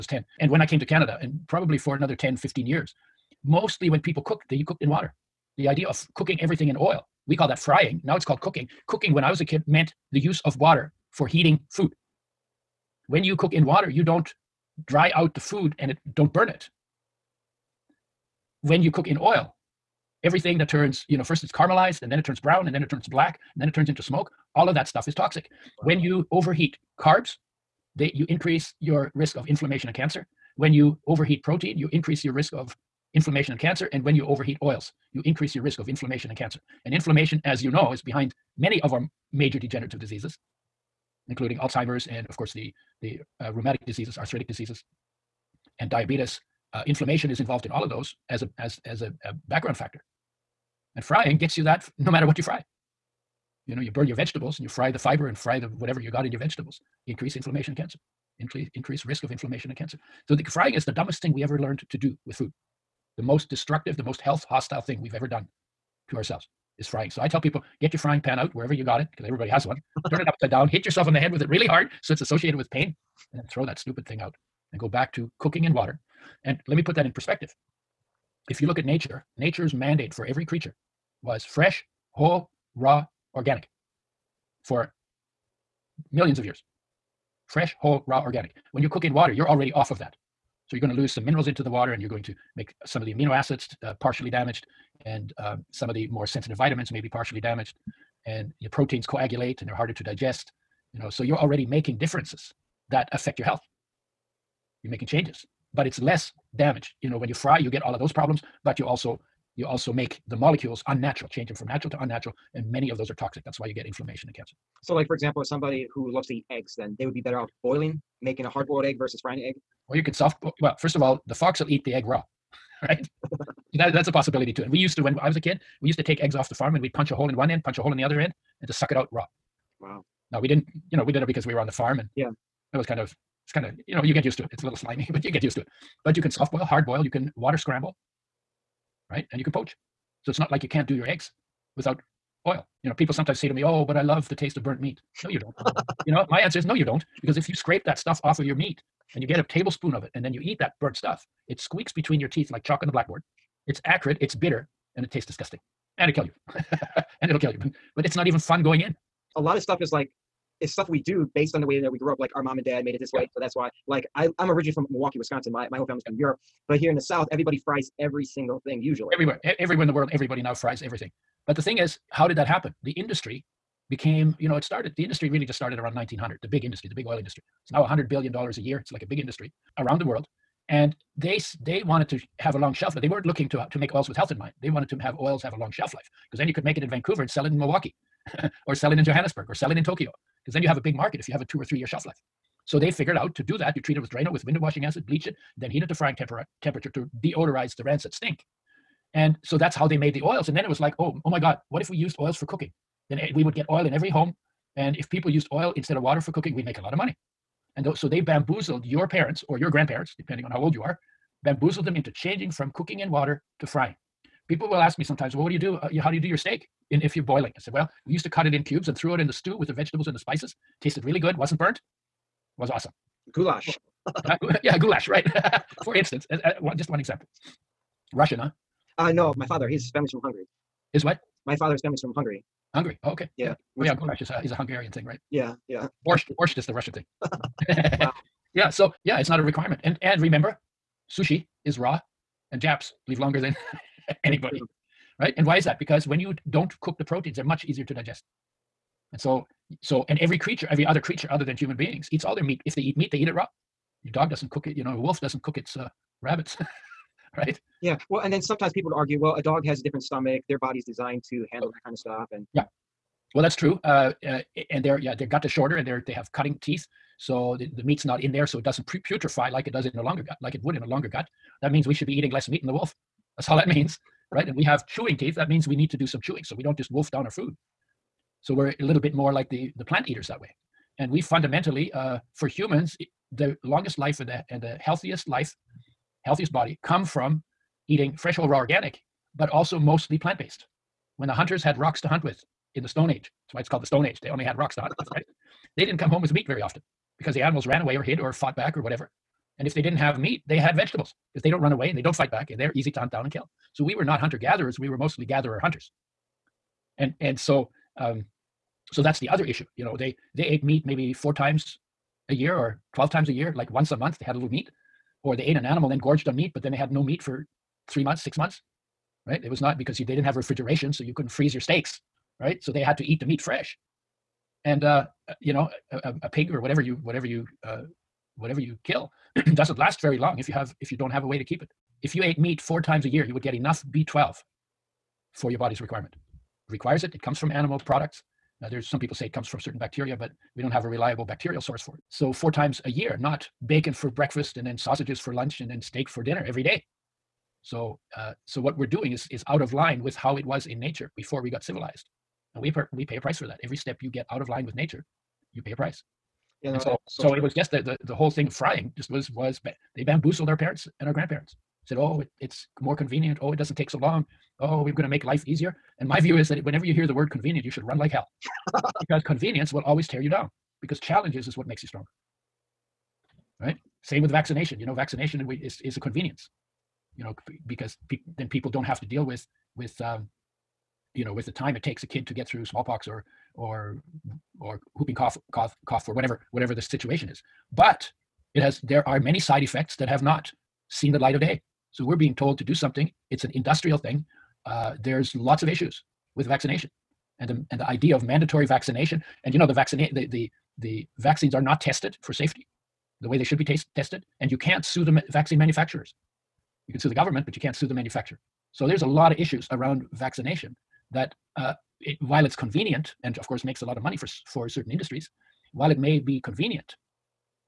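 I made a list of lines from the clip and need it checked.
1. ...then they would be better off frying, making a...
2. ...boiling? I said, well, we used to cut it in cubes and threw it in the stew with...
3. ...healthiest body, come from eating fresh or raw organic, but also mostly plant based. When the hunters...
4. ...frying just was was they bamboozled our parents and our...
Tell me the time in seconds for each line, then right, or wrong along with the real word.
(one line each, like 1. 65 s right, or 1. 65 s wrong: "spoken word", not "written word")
1. 116 s wrong: "boiling", not "frying"
2. 217 s right
3. 286 s right
4. 358 s right.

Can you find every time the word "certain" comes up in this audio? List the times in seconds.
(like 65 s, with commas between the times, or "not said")
339 s, 414 s.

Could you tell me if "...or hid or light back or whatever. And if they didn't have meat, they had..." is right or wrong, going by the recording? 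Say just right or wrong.
wrong.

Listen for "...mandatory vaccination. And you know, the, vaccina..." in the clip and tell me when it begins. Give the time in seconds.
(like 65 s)
398 s.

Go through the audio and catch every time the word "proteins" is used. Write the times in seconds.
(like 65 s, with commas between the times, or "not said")
31 s, 98 s, 247 s.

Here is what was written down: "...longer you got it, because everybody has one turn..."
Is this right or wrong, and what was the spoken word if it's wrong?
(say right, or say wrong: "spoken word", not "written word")
wrong: "wherever", not "longer".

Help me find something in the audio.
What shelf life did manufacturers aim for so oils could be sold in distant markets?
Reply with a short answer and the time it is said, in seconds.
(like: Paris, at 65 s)
2 or 3 years, at 191 s.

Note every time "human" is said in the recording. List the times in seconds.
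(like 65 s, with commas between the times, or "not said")
251 s, 282 s.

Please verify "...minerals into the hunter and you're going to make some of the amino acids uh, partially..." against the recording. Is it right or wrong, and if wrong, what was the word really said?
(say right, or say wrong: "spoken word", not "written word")
wrong: "water", not "hunter".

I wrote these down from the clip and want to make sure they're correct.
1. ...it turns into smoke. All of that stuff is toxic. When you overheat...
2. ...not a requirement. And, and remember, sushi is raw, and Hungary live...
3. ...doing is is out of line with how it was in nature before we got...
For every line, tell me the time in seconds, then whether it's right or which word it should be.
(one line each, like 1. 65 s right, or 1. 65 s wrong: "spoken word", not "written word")
1. 23 s right
2. 239 s wrong: "Japs", not "Hungary"
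3. 348 s right.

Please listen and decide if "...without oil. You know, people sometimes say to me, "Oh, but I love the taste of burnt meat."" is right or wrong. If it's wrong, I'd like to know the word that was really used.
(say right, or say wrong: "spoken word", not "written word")
right.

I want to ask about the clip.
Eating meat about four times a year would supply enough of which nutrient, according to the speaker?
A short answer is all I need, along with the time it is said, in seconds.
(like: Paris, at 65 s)
B12, at 333 s.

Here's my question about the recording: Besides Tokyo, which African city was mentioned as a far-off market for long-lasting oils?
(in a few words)
Johannesburg.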